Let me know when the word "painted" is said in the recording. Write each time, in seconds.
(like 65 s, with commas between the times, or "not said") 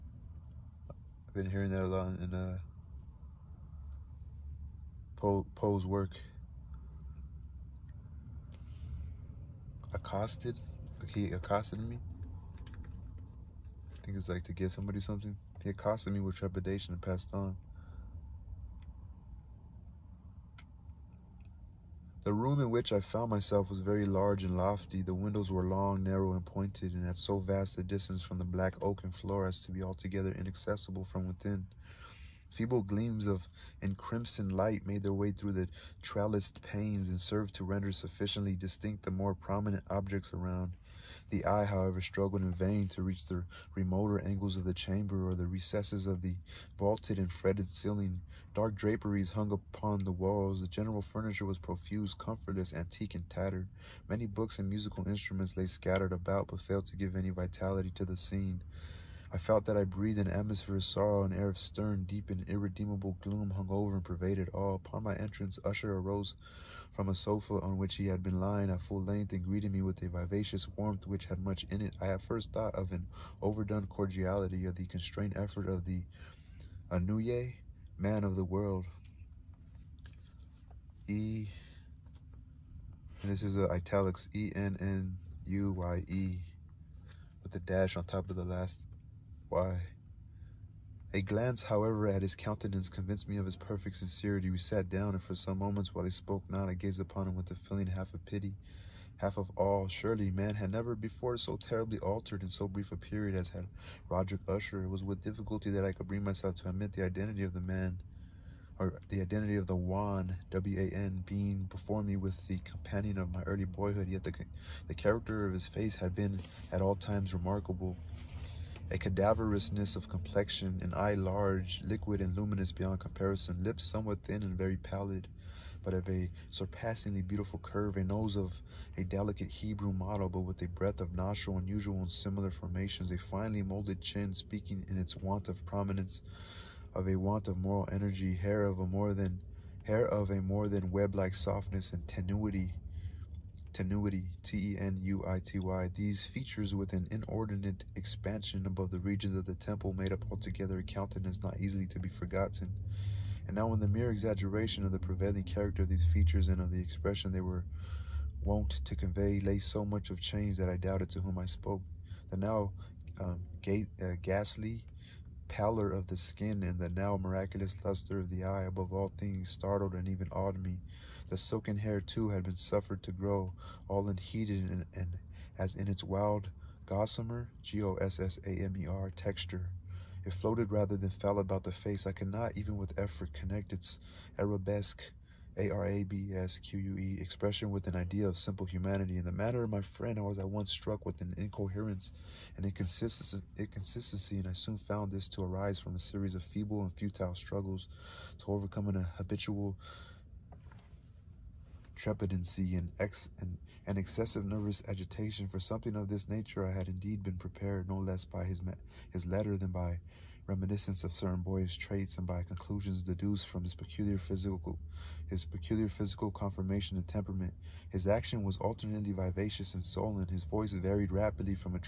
not said.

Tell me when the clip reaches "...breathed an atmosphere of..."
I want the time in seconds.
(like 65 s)
59 s.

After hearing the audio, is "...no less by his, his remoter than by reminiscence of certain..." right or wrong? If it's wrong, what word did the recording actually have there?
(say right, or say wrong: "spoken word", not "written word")
wrong: "letter", not "remoter".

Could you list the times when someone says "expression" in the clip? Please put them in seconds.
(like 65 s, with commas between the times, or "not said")
156 s, 187 s.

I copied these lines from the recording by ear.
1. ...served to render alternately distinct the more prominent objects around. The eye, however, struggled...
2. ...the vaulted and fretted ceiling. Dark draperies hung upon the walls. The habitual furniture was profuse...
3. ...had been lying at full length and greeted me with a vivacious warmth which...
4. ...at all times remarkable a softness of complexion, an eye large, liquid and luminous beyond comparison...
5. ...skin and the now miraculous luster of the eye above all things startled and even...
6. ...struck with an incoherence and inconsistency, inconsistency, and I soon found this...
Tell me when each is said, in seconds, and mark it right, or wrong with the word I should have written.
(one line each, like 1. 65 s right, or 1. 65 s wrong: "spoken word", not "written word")
1. 37 s wrong: "sufficiently", not "alternately"
2. 46 s wrong: "general", not "habitual"
3. 68 s right
4. 116 s wrong: "cadaverousness", not "softness"
5. 166 s right
6. 190 s right.